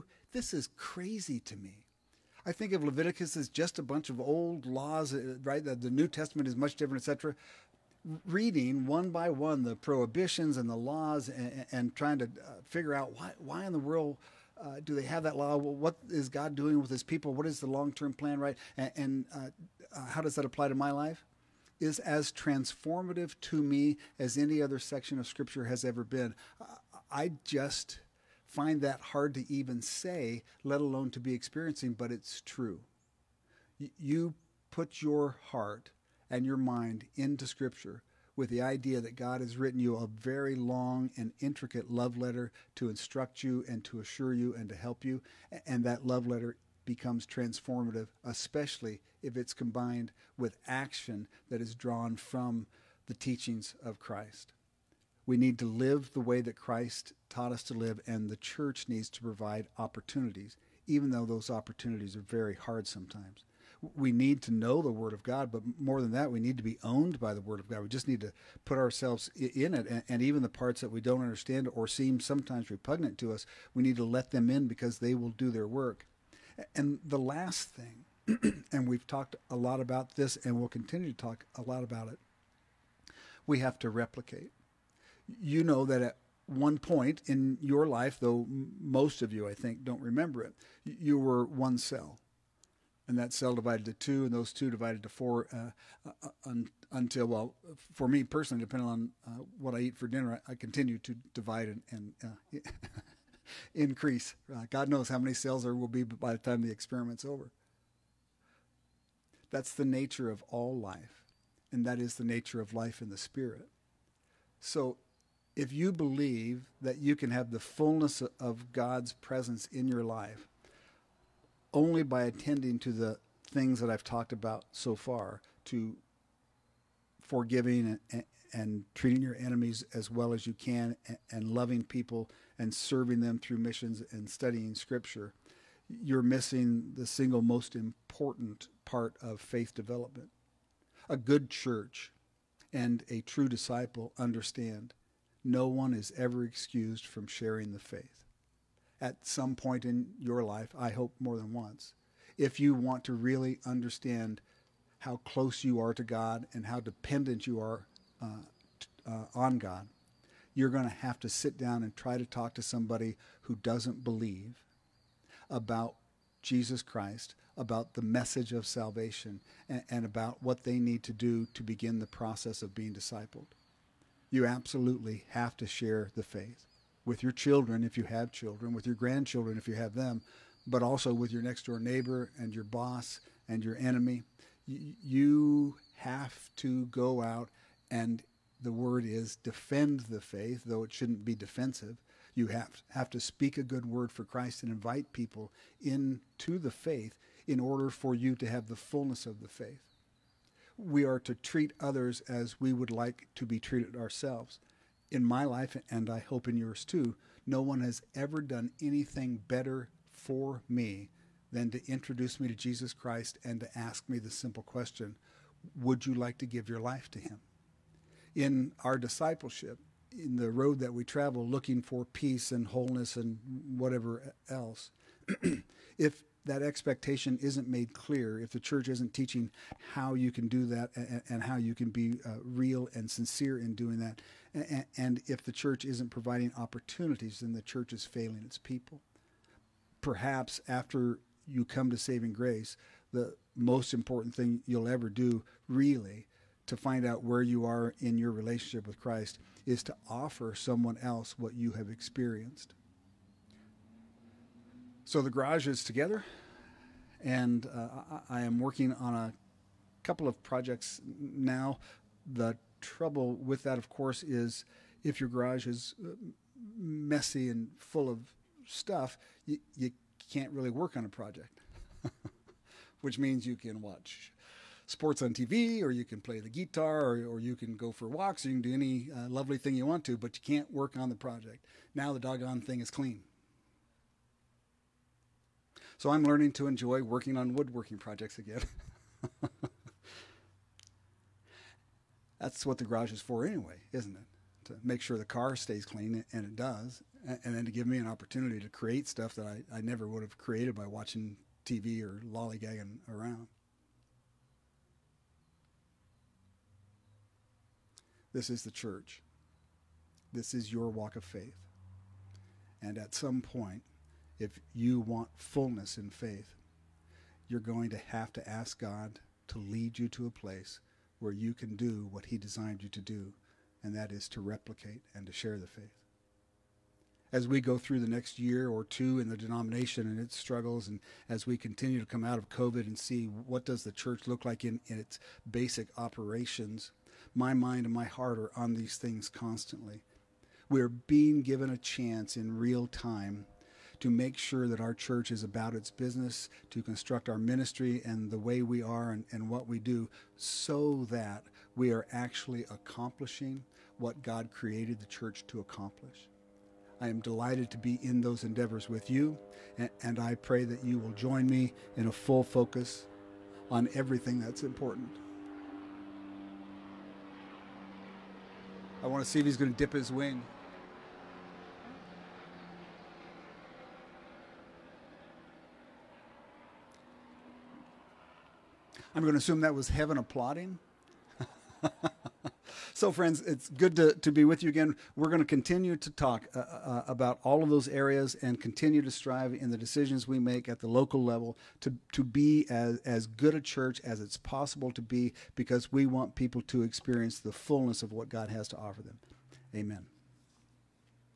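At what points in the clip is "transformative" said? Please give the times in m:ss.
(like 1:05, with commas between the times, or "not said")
0:22, 0:47.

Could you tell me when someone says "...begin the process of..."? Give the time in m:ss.
2:51.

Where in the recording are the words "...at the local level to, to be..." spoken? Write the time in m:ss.
6:30.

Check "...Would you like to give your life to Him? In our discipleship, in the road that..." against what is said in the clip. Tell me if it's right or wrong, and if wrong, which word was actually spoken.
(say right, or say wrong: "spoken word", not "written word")
right.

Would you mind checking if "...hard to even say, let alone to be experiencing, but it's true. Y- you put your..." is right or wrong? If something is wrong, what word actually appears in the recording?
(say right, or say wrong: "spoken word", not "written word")
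right.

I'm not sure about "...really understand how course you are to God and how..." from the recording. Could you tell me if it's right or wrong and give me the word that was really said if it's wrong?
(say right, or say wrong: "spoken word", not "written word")
wrong: "close", not "course".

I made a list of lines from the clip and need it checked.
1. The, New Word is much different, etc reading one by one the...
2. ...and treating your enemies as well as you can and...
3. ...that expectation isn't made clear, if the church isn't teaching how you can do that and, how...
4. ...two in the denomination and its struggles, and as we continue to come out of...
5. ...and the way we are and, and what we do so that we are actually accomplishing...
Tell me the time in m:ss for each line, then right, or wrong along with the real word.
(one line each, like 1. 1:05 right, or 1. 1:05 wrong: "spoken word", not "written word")
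1. 0:05 wrong: "Testament", not "Word"
2. 2:08 right
3. 3:46 right
4. 5:28 right
5. 5:48 right.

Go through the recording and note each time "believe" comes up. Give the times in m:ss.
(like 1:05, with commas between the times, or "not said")
1:55, 2:44.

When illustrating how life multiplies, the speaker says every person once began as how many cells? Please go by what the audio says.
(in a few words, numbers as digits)
1.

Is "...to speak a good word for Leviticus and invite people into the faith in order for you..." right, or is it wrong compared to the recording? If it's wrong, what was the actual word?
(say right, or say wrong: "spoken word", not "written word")
wrong: "Christ", not "Leviticus".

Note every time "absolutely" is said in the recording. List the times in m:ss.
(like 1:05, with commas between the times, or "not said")
2:54.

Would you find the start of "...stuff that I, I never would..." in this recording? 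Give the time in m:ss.
4:59.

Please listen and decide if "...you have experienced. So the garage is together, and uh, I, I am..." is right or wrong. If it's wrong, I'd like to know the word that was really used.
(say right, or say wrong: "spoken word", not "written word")
right.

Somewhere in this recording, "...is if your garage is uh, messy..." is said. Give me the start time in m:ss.
4:24.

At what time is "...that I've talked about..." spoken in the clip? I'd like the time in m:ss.
2:03.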